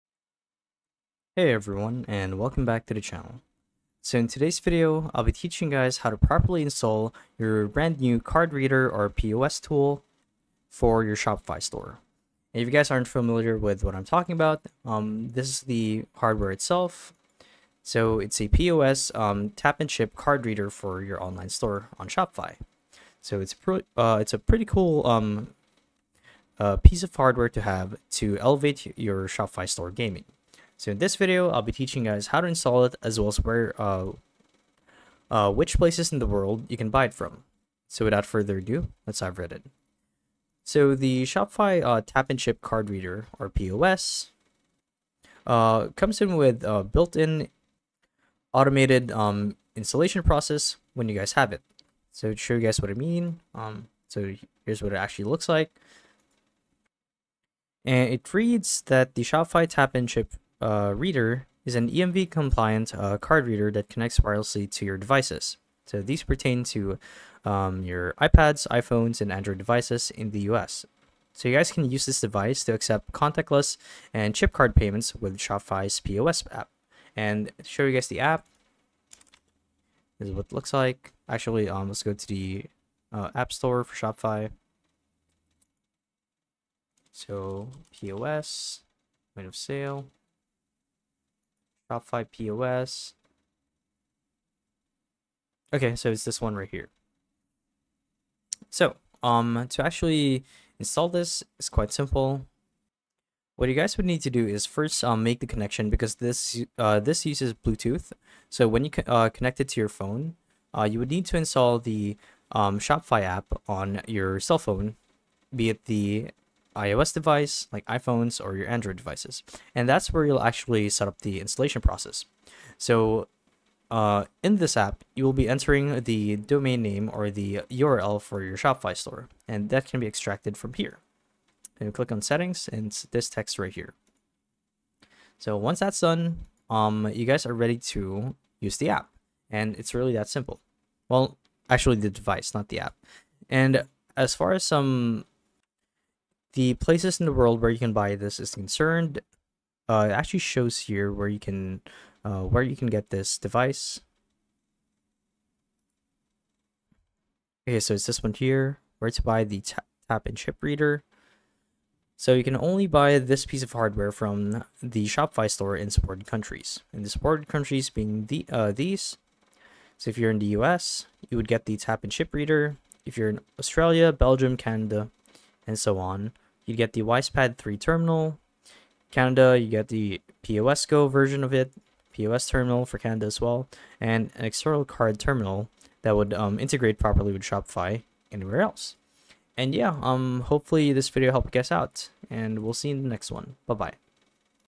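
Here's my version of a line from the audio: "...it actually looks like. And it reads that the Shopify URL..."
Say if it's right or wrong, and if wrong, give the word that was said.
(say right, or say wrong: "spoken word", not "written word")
wrong: "Tap", not "URL".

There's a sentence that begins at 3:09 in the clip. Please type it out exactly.
And yeah, um, hopefully this video helped you guys out, and we'll see you in the next one.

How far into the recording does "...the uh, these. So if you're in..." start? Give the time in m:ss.
2:48.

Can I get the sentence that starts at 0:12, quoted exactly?
And if you guys aren't familiar with what I'm talking about, um, this is the hardware itself.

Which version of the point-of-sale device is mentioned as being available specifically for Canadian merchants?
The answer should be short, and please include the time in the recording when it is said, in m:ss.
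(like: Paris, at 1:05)
POS Go, at 3:00.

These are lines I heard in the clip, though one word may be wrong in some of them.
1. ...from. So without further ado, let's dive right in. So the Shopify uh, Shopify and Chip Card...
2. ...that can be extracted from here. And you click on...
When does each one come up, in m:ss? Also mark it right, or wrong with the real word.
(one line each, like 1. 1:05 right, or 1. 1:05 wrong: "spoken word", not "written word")
1. 0:37 wrong: "Tap", not "Shopify"
2. 2:09 right.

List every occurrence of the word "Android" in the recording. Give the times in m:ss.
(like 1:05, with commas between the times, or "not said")
1:09, 1:58.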